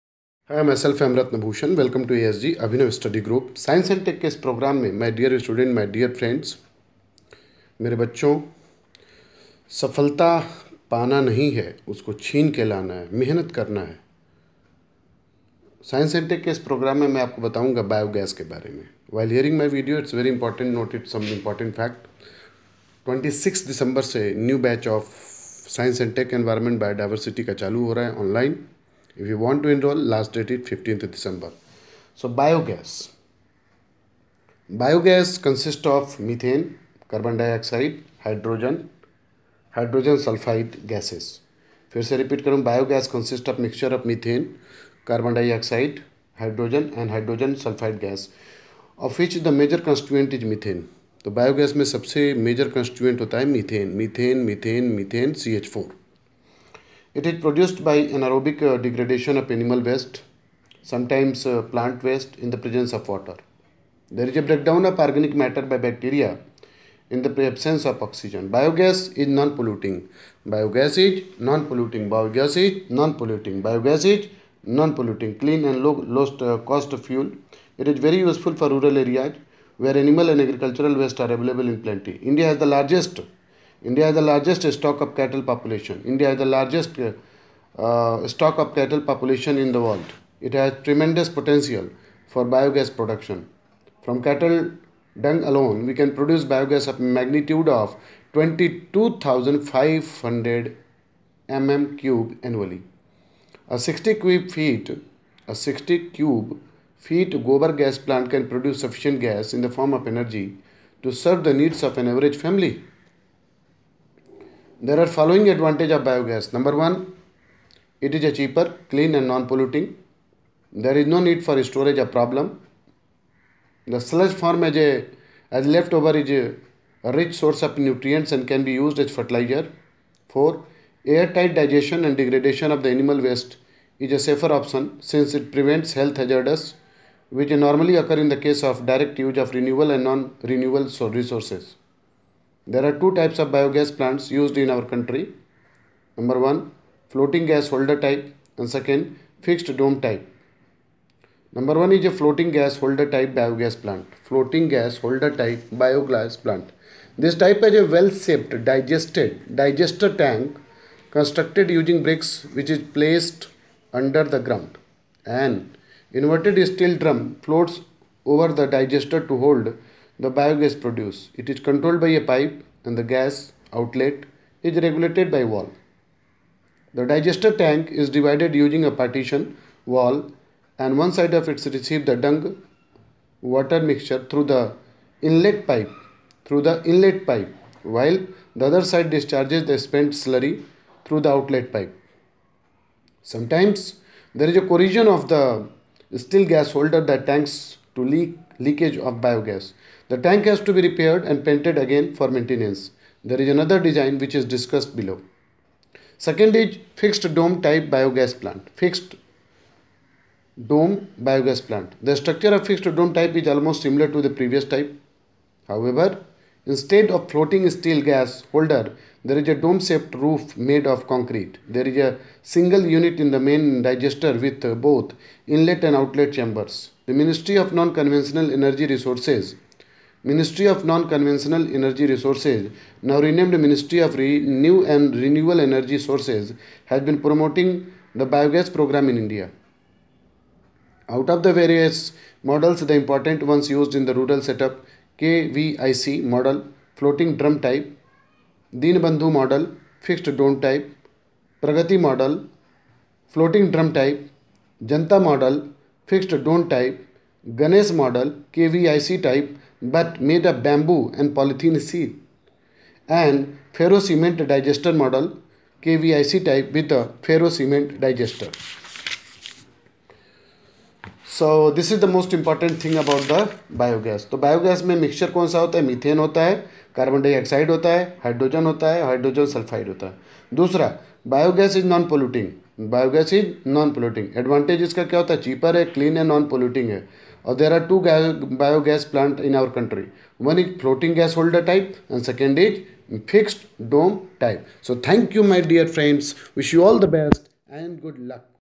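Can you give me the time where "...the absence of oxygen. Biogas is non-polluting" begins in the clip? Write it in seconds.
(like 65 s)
67 s.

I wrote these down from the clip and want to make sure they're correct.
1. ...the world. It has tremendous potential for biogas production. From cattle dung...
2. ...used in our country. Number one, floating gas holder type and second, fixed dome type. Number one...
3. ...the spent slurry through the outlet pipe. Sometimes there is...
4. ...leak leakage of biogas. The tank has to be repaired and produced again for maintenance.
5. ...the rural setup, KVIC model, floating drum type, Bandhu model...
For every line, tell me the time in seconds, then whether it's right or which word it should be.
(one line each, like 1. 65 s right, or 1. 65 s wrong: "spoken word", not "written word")
1. 89 s right
2. 144 s right
3. 189 s right
4. 198 s wrong: "painted", not "produced"
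5. 244 s right.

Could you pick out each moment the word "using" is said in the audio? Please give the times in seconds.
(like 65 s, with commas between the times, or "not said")
161 s, 178 s.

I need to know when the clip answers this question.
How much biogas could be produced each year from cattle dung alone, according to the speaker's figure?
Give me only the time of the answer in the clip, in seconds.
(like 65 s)
98 s.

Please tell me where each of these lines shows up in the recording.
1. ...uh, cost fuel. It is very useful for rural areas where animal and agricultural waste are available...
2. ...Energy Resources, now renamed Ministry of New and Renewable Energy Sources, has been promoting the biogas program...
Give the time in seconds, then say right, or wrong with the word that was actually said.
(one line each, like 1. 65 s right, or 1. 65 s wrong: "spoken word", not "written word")
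1. 76 s right
2. 231 s right.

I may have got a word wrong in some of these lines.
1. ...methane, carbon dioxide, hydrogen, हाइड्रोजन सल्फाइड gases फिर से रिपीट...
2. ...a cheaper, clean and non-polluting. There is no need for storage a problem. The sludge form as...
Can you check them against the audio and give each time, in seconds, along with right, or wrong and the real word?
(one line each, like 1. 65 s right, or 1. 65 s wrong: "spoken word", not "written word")
1. 36 s right
2. 118 s right.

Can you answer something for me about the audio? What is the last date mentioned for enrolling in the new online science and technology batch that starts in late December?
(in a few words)
15th December.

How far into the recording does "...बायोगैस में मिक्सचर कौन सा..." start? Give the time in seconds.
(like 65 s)
274 s.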